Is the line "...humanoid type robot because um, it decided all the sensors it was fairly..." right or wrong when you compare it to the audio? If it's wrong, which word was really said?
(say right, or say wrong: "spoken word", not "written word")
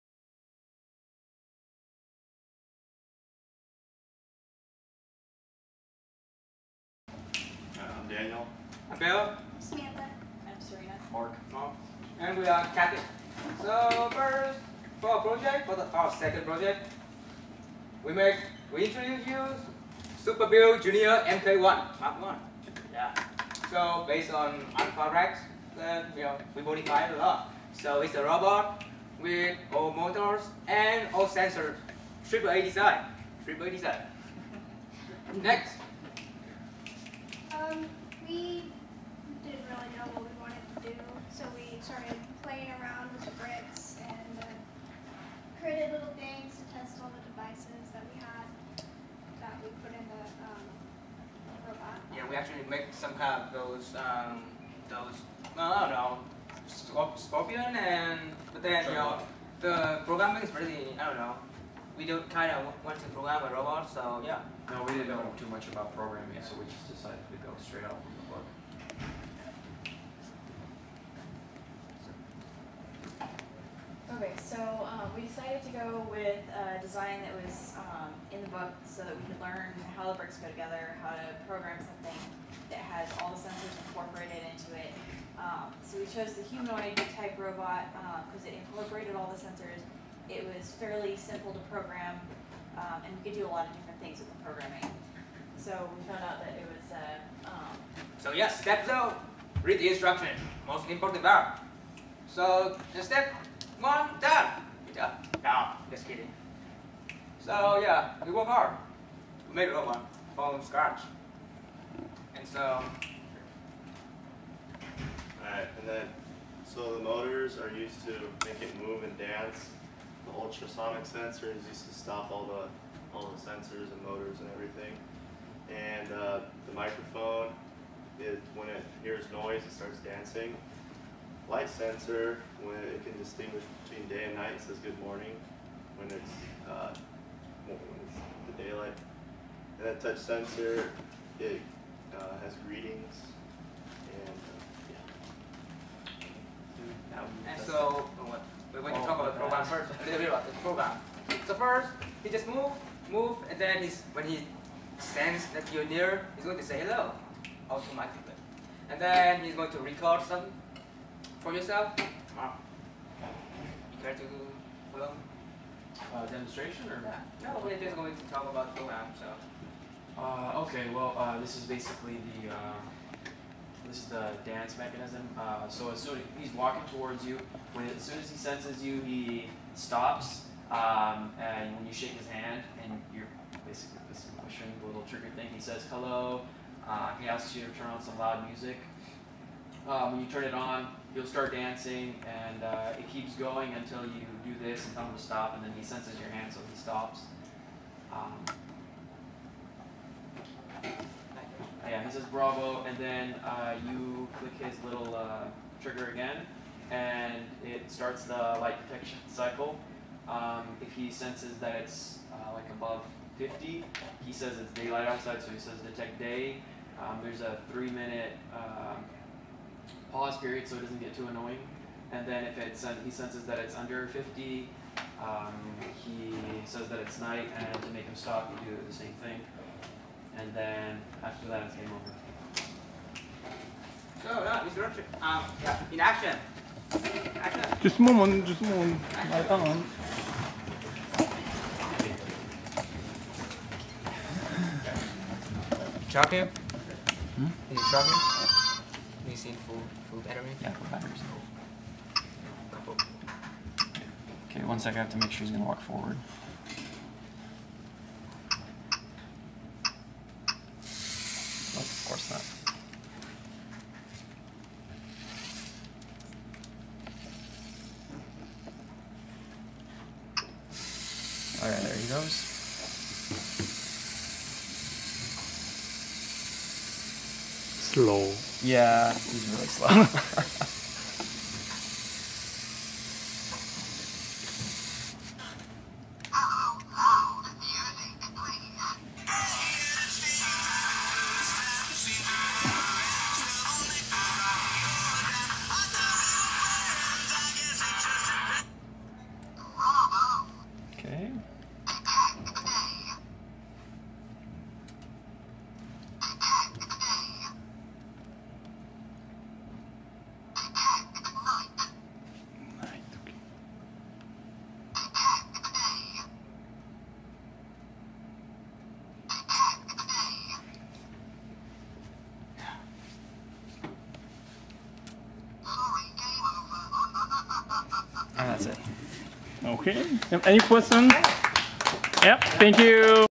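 wrong: "incorporated", not "decided".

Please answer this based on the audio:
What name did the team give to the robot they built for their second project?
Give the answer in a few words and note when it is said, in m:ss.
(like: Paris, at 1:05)
Super Bill Junior MK1, at 0:20.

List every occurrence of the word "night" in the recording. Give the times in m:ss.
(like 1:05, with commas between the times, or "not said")
2:14, 3:47.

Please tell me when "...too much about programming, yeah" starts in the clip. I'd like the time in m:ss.
1:05.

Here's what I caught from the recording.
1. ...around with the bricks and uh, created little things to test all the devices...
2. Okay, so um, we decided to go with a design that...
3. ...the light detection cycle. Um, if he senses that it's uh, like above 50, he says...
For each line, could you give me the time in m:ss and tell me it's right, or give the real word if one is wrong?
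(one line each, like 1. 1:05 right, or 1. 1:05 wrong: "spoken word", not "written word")
1. 0:42 right
2. 1:14 right
3. 3:28 right.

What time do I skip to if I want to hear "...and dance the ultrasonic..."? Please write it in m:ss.
1:59.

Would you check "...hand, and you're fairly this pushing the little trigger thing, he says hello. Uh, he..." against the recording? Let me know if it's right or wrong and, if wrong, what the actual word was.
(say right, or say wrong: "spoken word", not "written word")
wrong: "basically", not "fairly".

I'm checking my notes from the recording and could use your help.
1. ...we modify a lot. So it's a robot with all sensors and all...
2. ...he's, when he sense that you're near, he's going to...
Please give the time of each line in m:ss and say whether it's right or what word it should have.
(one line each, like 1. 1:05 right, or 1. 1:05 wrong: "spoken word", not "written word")
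1. 0:26 wrong: "motors", not "sensors"
2. 2:33 right.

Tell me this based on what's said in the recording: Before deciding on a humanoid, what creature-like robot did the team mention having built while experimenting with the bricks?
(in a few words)
Scorpion.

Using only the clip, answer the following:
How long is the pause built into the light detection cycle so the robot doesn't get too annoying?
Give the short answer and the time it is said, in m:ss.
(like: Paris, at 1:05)
3 minutes, at 3:37.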